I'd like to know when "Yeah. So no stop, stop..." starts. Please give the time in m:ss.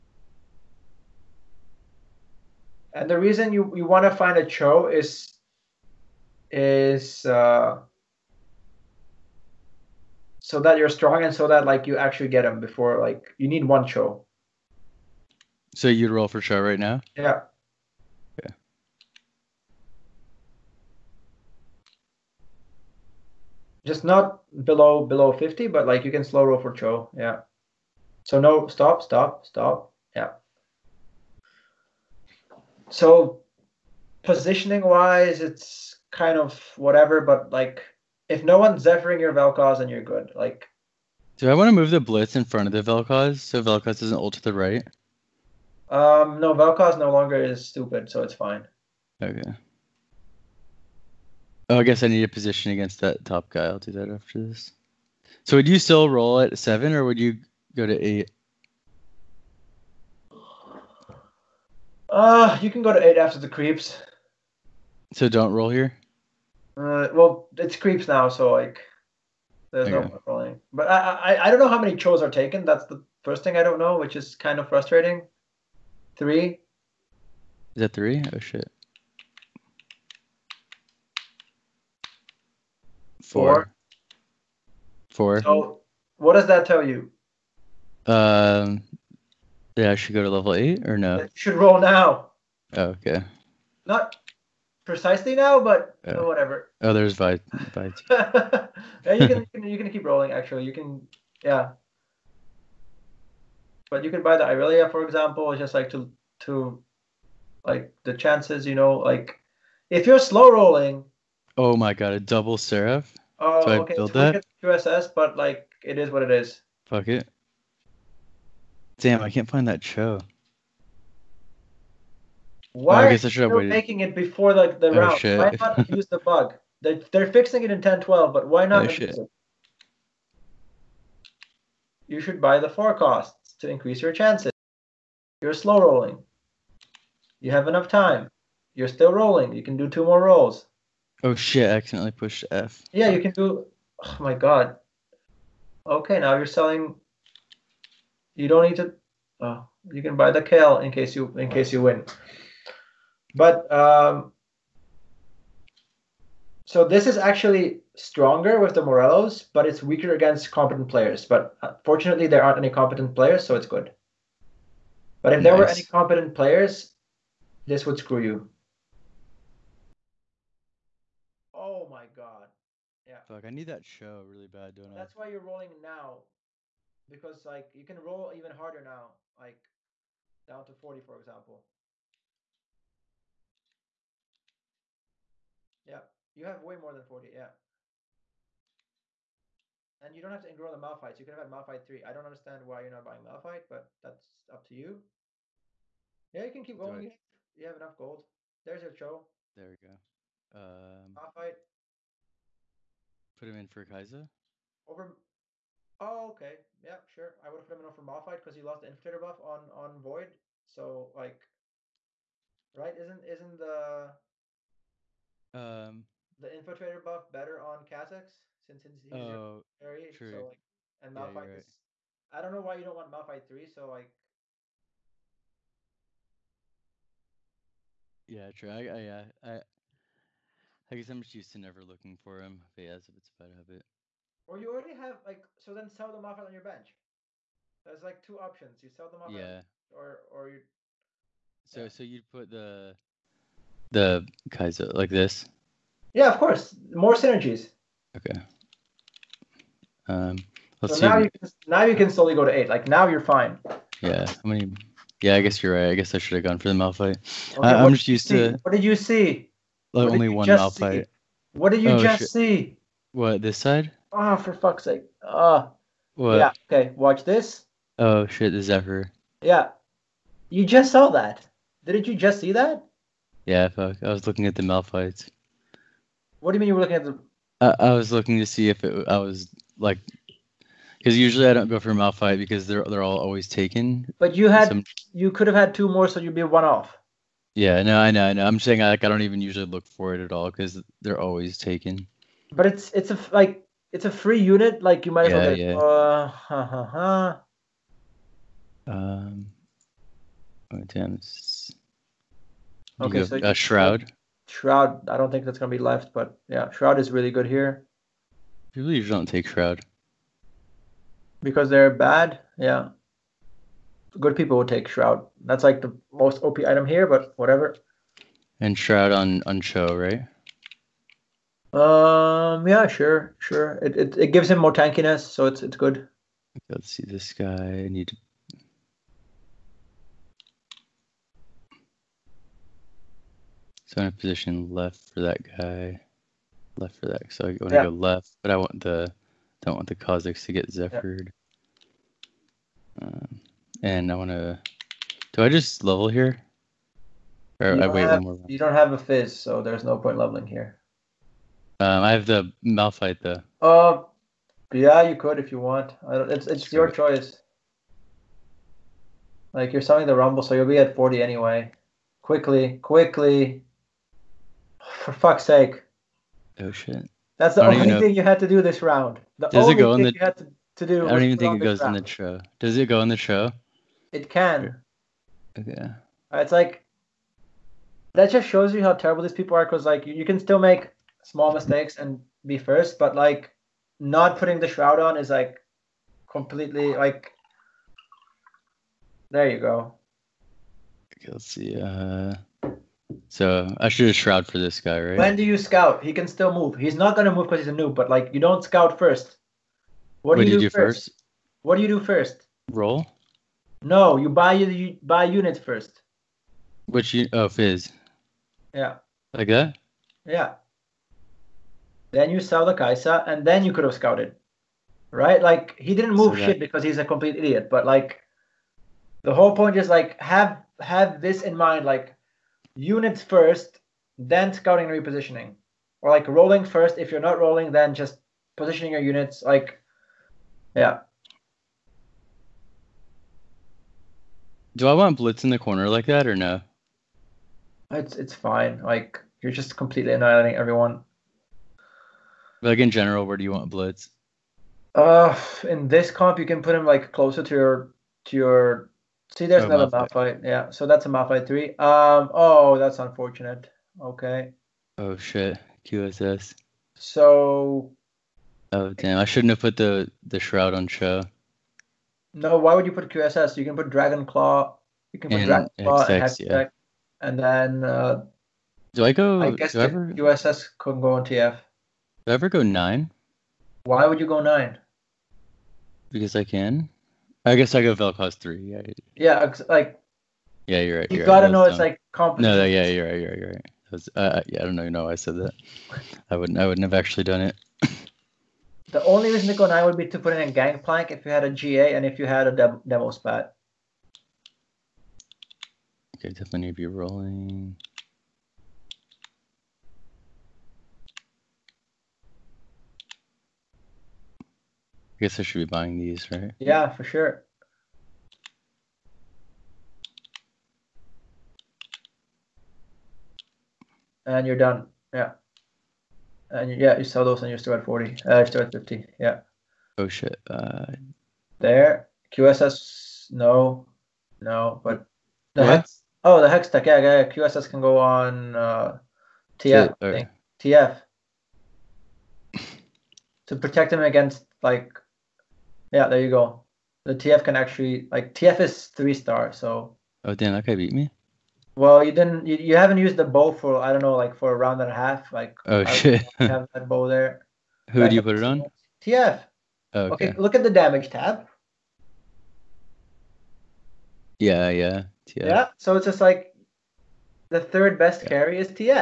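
0:27.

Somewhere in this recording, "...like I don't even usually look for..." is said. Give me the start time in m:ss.
4:48.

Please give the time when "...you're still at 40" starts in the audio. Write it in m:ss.
8:37.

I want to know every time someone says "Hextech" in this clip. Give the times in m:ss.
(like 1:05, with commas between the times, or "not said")
7:46, 8:46.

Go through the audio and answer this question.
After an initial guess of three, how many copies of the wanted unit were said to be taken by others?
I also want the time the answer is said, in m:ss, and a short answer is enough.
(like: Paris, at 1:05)
4, at 1:23.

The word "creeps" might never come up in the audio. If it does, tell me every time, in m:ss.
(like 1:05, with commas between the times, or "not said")
1:03, 1:07.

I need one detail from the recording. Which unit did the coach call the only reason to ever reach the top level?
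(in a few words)
Gangplank.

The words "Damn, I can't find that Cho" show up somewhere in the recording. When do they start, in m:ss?
1:58.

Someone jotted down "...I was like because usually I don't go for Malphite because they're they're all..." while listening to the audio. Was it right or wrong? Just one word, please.
right.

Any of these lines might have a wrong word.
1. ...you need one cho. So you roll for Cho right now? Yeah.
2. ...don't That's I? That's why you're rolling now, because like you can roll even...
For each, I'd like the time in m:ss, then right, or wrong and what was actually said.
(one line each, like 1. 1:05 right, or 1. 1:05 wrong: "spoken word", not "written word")
1. 0:13 right
2. 2:54 right.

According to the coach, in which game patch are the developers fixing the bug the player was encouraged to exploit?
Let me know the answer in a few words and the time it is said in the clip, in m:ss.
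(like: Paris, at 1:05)
10.12, at 2:07.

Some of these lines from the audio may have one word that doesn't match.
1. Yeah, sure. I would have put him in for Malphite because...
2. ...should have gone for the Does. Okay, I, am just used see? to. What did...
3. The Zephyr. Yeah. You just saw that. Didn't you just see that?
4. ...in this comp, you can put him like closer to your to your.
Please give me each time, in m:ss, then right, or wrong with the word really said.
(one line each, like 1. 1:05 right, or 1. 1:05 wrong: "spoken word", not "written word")
1. 3:26 right
2. 4:16 wrong: "Malphite", not "Does"
3. 4:28 right
4. 7:25 right.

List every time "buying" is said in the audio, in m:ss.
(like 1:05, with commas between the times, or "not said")
3:13, 8:25.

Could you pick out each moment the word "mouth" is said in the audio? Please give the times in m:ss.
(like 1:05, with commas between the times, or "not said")
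4:20, 4:34.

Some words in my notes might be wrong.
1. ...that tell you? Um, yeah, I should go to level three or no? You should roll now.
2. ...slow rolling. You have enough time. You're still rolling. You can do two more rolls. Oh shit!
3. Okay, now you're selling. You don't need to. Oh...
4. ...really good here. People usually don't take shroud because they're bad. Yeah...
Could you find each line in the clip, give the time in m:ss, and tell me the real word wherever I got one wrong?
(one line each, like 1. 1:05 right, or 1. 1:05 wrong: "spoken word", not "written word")
1. 1:26 wrong: "eight", not "three"
2. 2:15 right
3. 2:25 right
4. 5:07 right.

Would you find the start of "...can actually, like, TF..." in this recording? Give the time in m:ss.
8:57.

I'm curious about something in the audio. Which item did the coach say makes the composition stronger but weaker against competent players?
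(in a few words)
Morellos.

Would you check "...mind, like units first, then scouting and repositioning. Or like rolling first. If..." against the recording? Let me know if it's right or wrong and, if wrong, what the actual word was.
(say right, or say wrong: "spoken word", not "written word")
right.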